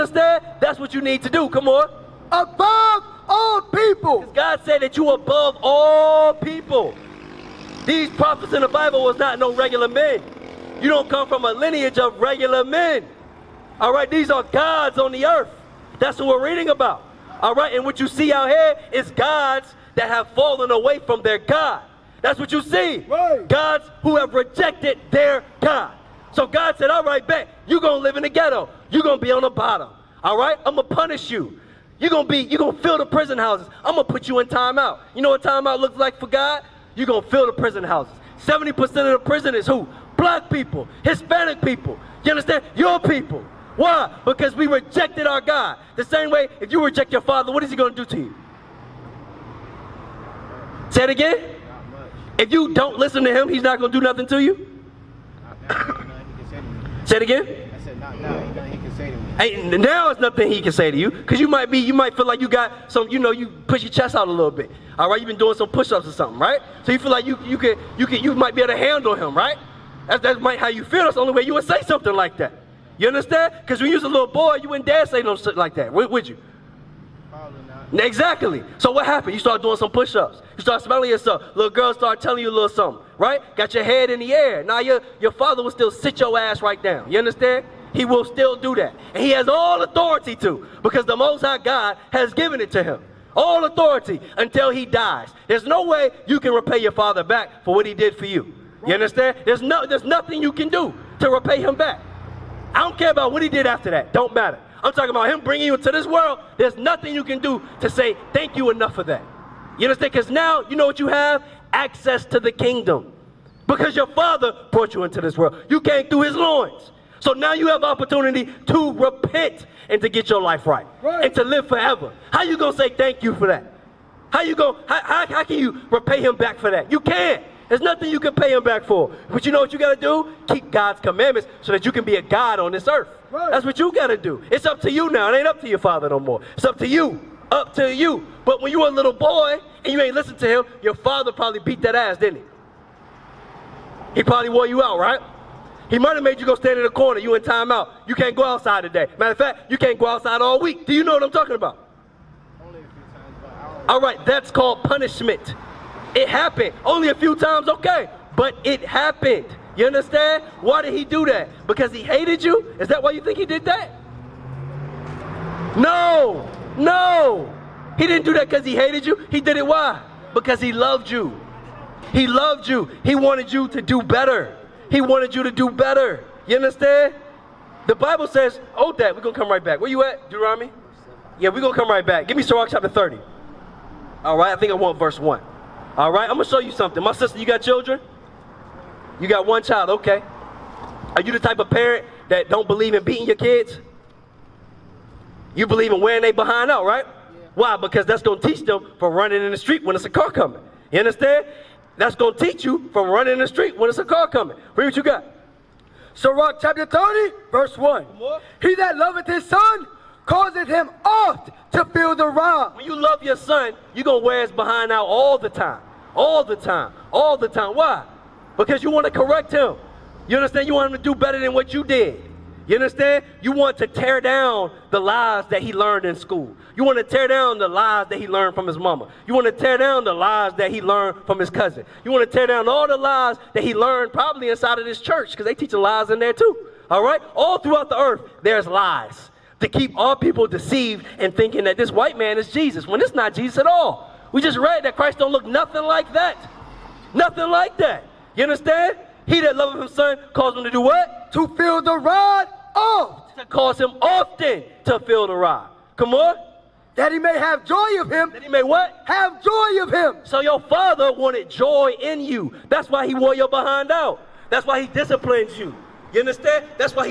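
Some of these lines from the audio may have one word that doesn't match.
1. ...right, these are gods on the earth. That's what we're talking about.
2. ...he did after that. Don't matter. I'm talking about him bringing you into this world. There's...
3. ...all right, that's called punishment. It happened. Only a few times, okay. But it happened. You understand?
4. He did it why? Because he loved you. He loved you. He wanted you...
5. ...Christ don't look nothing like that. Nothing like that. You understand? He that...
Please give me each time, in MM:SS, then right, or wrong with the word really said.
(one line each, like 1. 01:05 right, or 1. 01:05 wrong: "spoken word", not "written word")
1. 00:13 wrong: "reading", not "talking"
2. 01:43 right
3. 02:33 right
4. 02:49 right
5. 04:04 right.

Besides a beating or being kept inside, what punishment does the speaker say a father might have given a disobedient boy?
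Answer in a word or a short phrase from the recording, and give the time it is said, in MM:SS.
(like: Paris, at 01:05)
Stand in the corner, at 02:26.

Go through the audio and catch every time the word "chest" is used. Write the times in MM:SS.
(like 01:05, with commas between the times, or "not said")
01:03.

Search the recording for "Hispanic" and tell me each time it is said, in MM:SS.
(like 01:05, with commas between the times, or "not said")
00:41.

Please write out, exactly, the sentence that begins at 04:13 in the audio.
To cause him often to feel the rod.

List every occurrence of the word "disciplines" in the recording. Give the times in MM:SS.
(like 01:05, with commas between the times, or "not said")
04:24.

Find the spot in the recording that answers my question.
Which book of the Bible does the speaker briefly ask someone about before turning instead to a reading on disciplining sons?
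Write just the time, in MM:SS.
03:00.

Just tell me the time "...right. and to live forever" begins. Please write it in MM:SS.
02:01.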